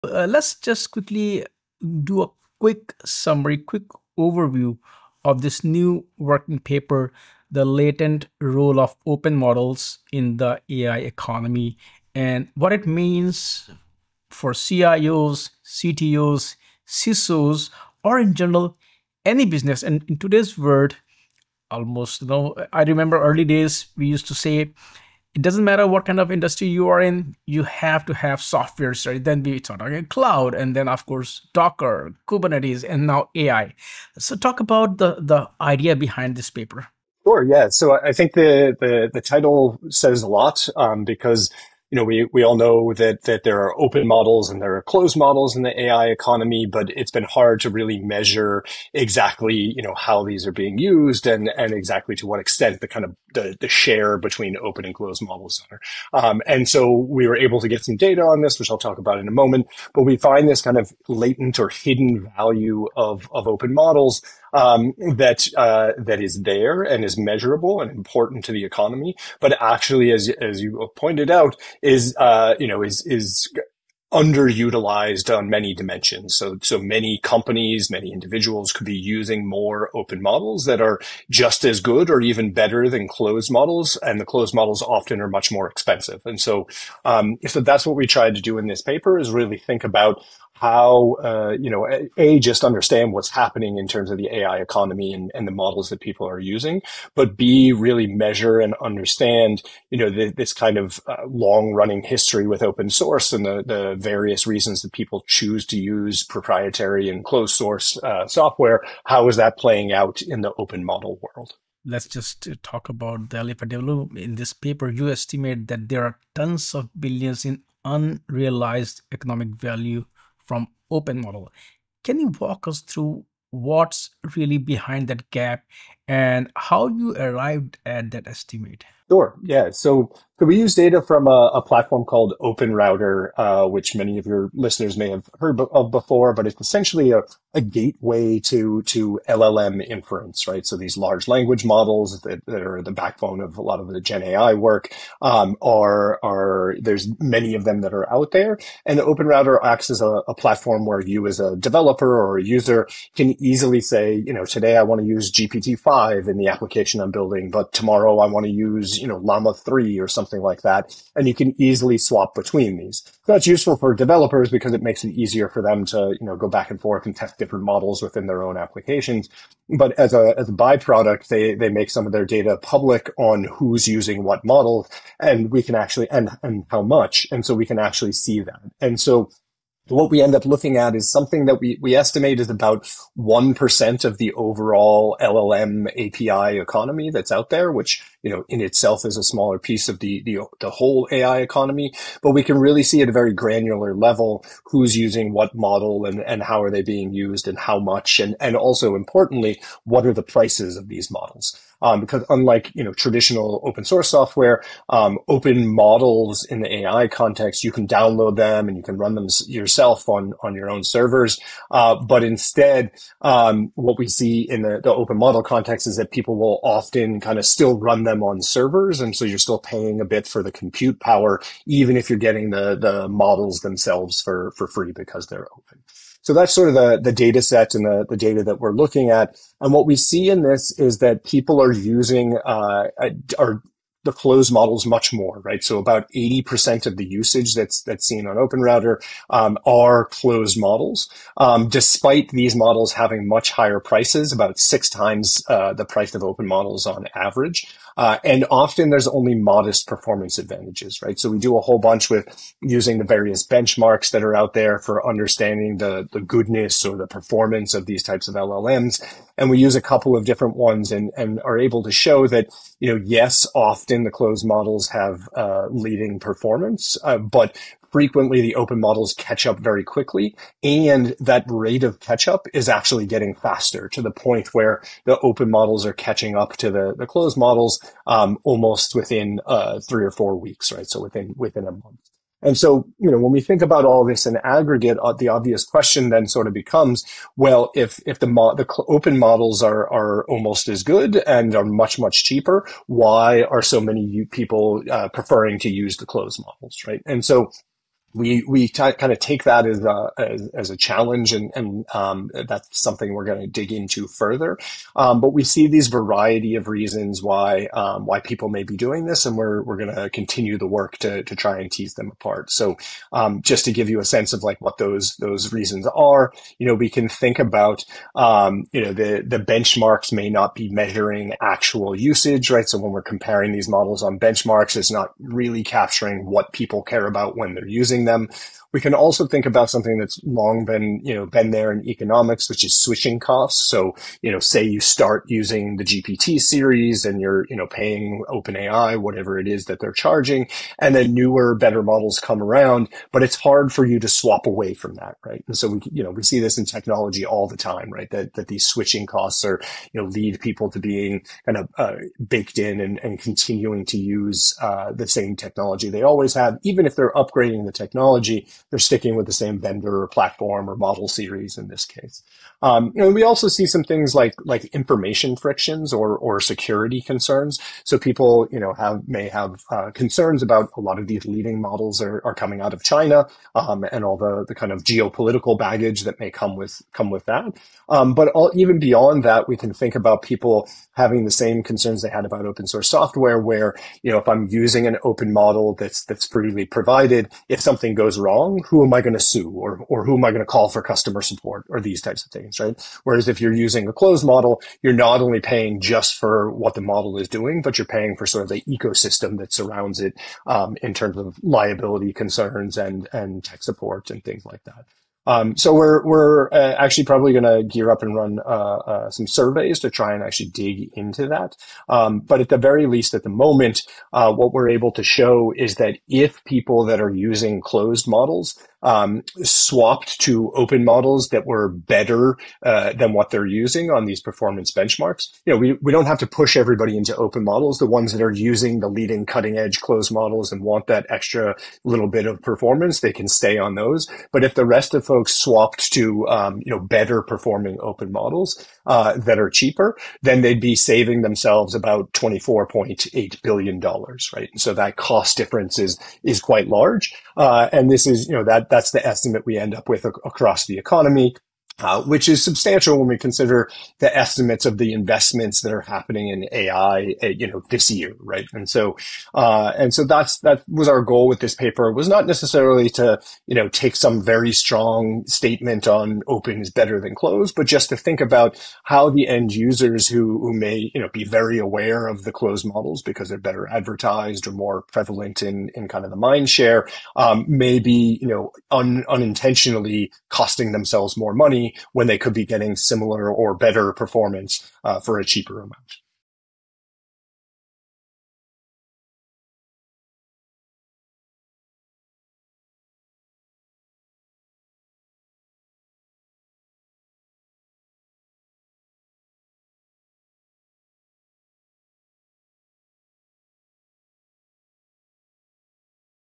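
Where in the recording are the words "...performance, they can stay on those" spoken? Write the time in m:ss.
7:12.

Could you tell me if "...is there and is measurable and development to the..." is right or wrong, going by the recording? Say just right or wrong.
wrong.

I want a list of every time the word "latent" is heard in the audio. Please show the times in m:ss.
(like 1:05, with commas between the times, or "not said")
0:07, 1:01.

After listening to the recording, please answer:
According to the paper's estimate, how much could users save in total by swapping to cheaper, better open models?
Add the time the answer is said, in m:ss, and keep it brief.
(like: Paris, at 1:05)
$24.8 billion, at 7:22.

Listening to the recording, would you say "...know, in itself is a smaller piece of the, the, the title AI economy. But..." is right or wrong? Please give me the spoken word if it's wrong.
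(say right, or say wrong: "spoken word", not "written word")
wrong: "whole", not "title".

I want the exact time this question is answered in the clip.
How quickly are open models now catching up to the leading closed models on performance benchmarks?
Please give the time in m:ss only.
4:39.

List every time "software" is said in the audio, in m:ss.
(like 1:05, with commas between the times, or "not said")
0:28, 1:48, 3:24, 6:22.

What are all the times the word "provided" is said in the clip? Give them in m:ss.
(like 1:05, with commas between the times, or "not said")
6:26.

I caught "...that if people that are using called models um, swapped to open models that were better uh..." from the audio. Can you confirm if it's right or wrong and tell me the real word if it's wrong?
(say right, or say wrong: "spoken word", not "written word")
wrong: "closed", not "called".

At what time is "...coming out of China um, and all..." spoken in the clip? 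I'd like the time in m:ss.
6:12.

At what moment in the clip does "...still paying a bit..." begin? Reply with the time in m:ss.
3:39.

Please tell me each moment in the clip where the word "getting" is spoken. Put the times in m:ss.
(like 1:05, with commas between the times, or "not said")
3:42, 4:33, 8:02.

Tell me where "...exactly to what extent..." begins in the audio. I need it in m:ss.
0:51.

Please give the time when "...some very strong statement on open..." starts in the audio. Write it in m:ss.
7:43.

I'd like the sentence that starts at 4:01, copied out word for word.
Um, despite these models having much higher prices, about six times, uh, the price of open models on average.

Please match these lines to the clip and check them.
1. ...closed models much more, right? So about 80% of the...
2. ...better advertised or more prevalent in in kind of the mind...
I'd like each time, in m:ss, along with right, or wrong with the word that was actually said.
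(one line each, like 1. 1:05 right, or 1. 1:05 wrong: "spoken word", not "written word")
1. 3:54 right
2. 7:53 right.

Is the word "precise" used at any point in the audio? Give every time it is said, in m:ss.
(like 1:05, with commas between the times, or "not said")
not said.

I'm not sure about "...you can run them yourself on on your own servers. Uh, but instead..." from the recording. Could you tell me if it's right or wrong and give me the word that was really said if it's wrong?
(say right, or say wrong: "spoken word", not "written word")
right.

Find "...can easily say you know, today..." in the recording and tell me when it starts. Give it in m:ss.
2:33.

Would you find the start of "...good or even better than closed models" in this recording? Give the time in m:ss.
1:21.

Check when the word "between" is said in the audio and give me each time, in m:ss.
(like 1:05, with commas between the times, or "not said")
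0:54, 2:42.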